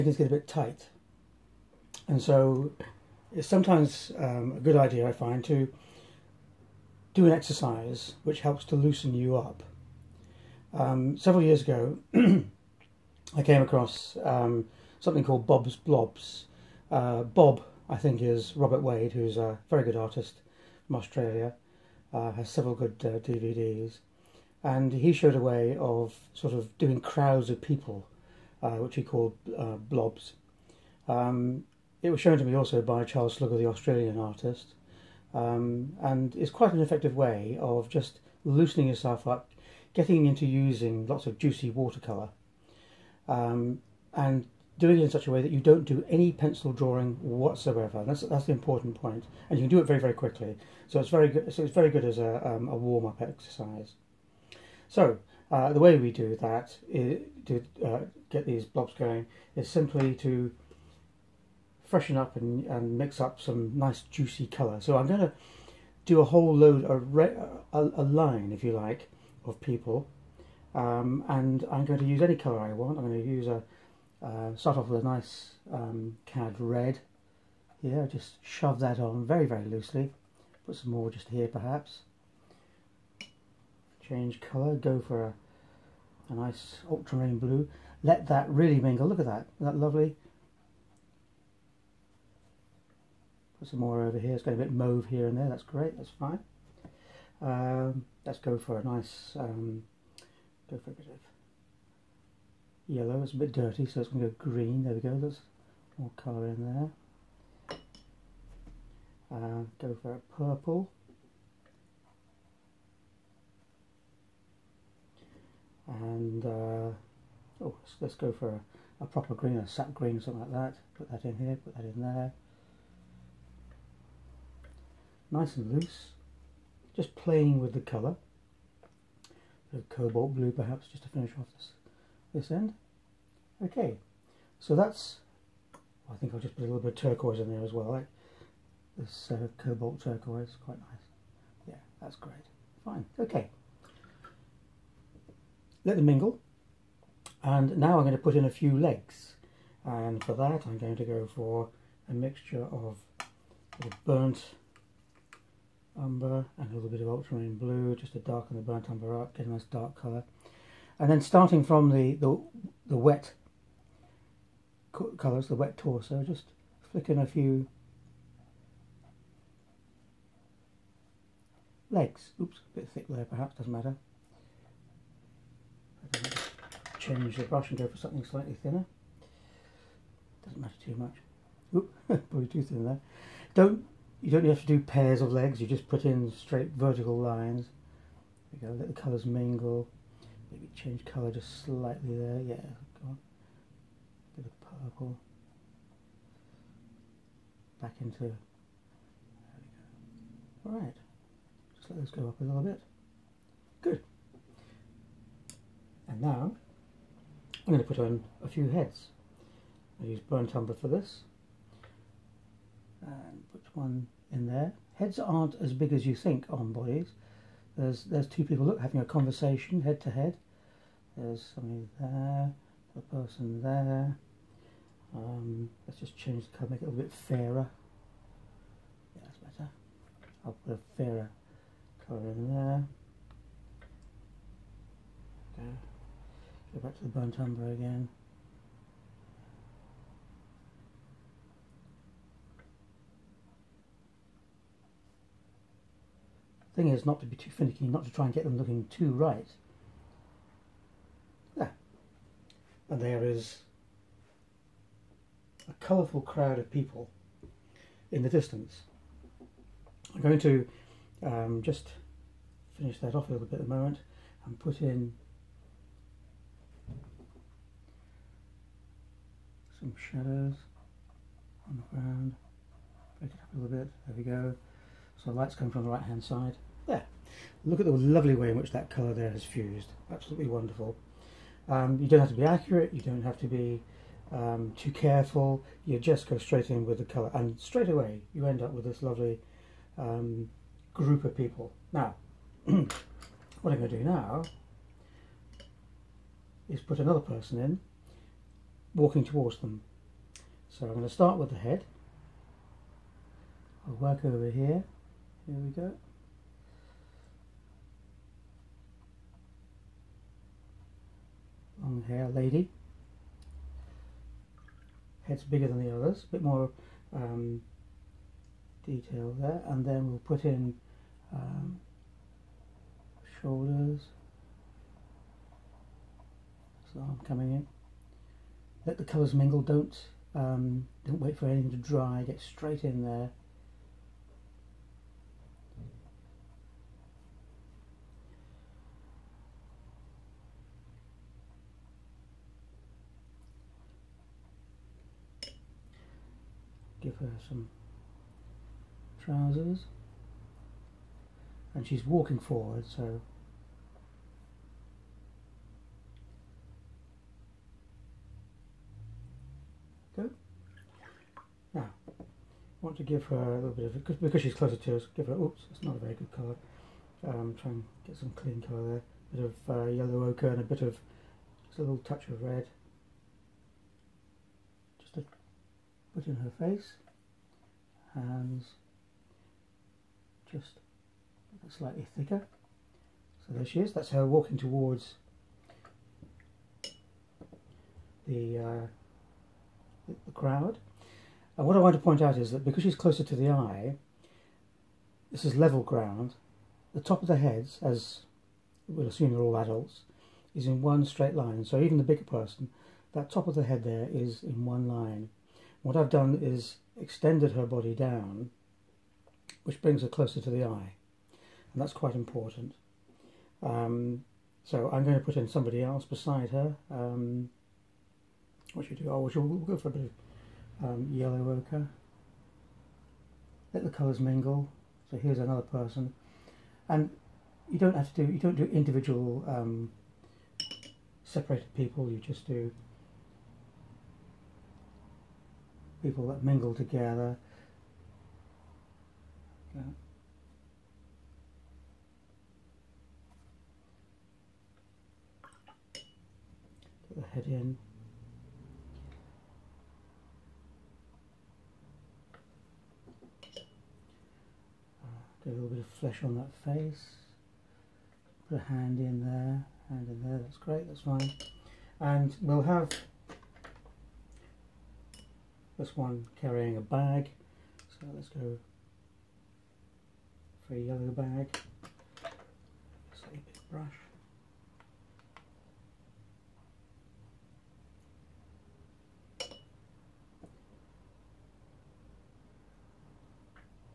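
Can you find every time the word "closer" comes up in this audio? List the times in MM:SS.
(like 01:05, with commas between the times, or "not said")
06:04, 06:32, 06:50.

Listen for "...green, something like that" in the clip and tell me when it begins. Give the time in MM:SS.
01:59.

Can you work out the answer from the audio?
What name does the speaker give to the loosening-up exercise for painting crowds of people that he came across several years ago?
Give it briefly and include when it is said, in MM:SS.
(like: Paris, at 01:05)
Bob's Blobs, at 00:15.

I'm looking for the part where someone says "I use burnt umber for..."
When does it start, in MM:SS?
03:30.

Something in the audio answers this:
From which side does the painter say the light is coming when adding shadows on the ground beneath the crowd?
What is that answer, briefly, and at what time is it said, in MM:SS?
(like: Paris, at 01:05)
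right hand side, at 04:35.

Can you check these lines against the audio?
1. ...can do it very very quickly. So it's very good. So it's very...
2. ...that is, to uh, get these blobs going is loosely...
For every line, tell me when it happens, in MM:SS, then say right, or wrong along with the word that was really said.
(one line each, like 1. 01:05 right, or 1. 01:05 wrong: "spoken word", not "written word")
1. 00:49 right
2. 00:56 wrong: "simply", not "loosely".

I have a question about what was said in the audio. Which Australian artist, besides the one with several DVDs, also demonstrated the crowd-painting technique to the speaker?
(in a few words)
Charles Slugger.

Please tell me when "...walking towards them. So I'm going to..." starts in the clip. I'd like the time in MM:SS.
04:58.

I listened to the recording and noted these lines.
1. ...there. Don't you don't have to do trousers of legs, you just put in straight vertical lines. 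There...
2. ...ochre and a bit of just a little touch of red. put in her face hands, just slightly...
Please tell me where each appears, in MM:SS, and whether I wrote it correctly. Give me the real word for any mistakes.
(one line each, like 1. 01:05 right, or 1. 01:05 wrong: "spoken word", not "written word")
1. 03:02 wrong: "pairs", not "trousers"
2. 06:10 right.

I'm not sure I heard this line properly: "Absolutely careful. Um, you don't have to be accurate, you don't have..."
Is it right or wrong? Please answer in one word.
wrong.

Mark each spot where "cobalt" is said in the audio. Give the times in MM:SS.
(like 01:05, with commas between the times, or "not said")
02:09, 02:19.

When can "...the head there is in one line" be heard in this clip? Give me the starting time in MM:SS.
06:43.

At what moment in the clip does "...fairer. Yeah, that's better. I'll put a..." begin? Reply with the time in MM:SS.
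03:47.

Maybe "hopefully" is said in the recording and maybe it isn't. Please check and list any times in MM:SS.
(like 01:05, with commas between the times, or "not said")
not said.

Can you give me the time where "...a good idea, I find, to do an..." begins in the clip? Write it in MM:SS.
00:04.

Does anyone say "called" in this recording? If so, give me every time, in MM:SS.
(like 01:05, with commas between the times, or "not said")
00:15, 00:29.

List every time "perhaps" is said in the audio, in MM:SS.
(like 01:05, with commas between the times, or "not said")
01:21, 02:10, 02:53.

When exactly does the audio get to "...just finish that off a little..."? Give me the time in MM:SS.
04:21.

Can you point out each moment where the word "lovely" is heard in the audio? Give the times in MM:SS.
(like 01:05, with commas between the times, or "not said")
01:29, 04:37, 04:49.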